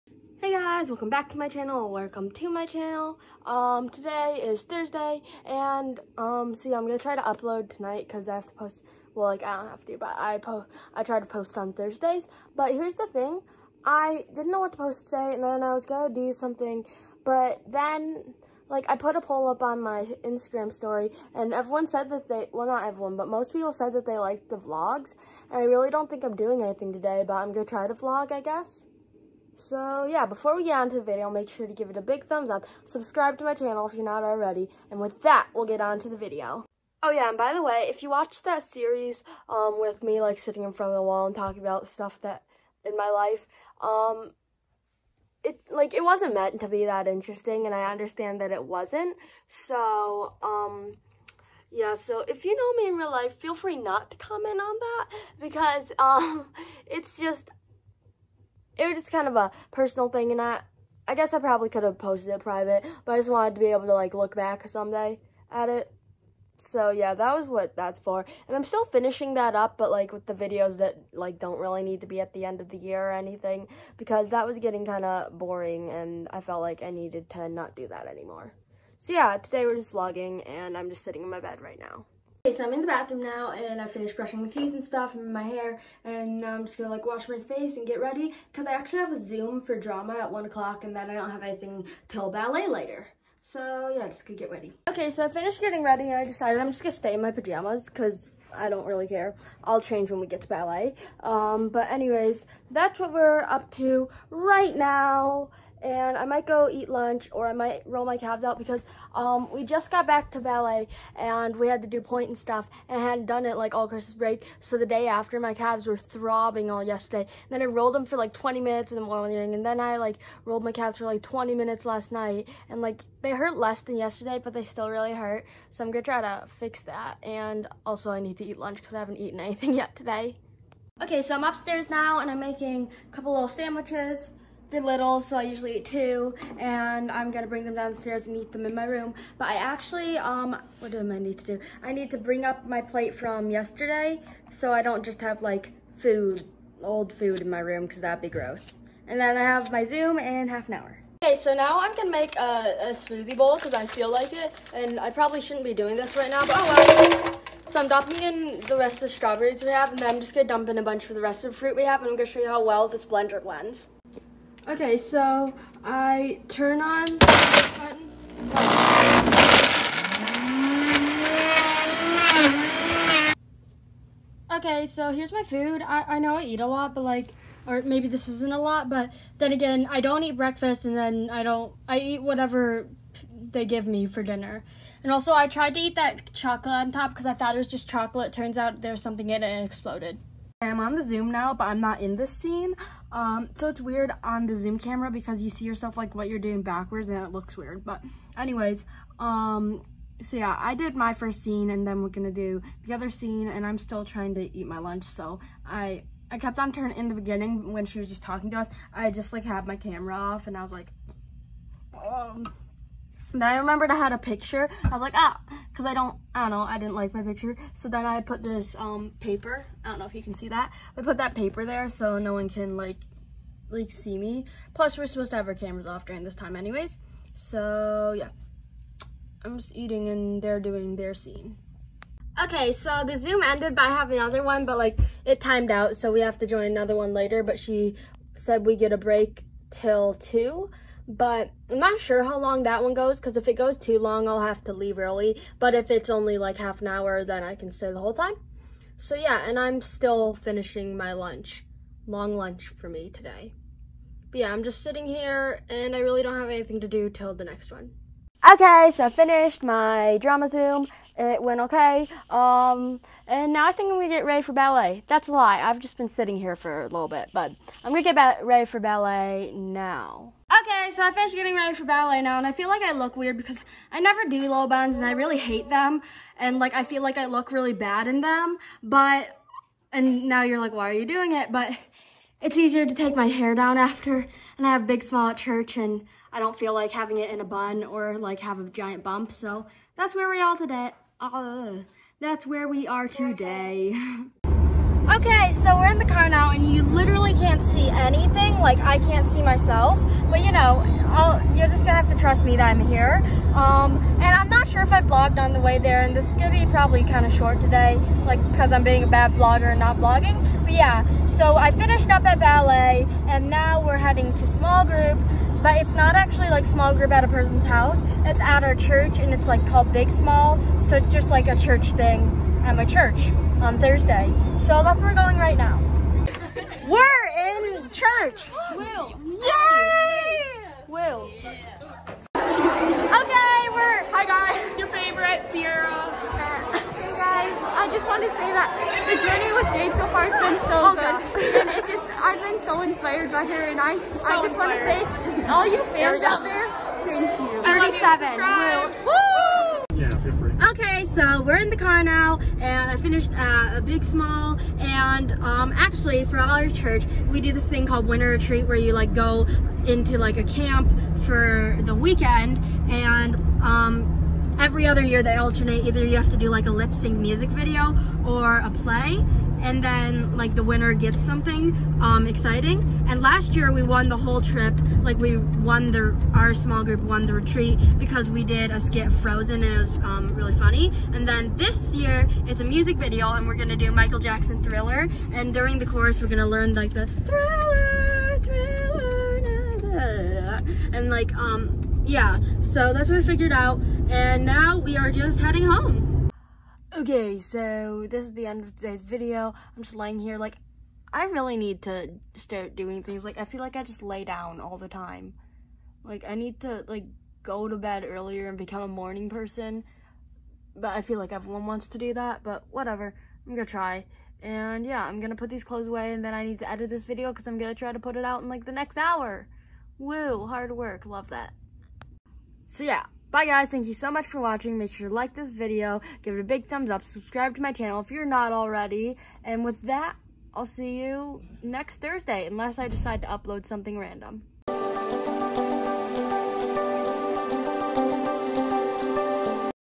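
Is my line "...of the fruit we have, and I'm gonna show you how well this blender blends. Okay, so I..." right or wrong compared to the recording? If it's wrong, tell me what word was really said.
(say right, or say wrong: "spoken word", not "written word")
right.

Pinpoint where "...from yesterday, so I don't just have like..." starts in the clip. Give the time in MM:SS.
02:23.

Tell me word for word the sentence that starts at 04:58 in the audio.
Like I can't see myself, but you know, I'll, you're just gonna have to trust me that I'm here.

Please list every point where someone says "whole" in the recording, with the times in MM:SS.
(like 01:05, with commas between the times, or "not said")
04:07, 06:14.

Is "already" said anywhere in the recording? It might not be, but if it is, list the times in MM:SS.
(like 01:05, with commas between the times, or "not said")
00:34, 07:08.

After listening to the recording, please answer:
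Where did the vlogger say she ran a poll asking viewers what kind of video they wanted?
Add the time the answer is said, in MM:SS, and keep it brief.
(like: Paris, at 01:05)
Instagram story, at 00:20.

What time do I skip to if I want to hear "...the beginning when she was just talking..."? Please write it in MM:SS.
03:27.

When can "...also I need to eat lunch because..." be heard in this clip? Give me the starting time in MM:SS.
02:07.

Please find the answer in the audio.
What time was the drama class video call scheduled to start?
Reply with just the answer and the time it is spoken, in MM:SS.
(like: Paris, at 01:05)
1 o'clock, at 01:30.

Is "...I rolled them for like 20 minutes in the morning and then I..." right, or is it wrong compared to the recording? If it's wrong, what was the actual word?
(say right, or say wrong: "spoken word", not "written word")
right.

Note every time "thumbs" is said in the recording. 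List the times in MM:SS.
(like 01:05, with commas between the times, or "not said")
00:32, 07:06.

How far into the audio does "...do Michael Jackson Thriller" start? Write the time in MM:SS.
06:23.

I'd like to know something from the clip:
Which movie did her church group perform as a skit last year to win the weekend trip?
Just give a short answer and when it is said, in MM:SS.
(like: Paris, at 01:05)
Frozen, at 06:19.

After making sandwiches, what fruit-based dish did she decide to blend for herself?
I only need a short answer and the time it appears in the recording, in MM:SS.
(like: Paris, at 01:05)
smoothie bowl, at 02:32.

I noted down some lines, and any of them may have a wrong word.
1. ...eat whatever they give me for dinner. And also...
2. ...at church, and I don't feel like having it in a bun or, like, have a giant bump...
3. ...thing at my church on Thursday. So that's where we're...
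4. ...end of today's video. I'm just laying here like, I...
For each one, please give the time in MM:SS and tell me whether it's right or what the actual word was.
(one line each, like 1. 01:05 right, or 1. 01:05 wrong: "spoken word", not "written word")
1. 03:01 right
2. 04:45 right
3. 05:21 right
4. 06:38 right.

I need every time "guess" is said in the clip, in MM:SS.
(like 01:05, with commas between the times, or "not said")
00:28, 01:01.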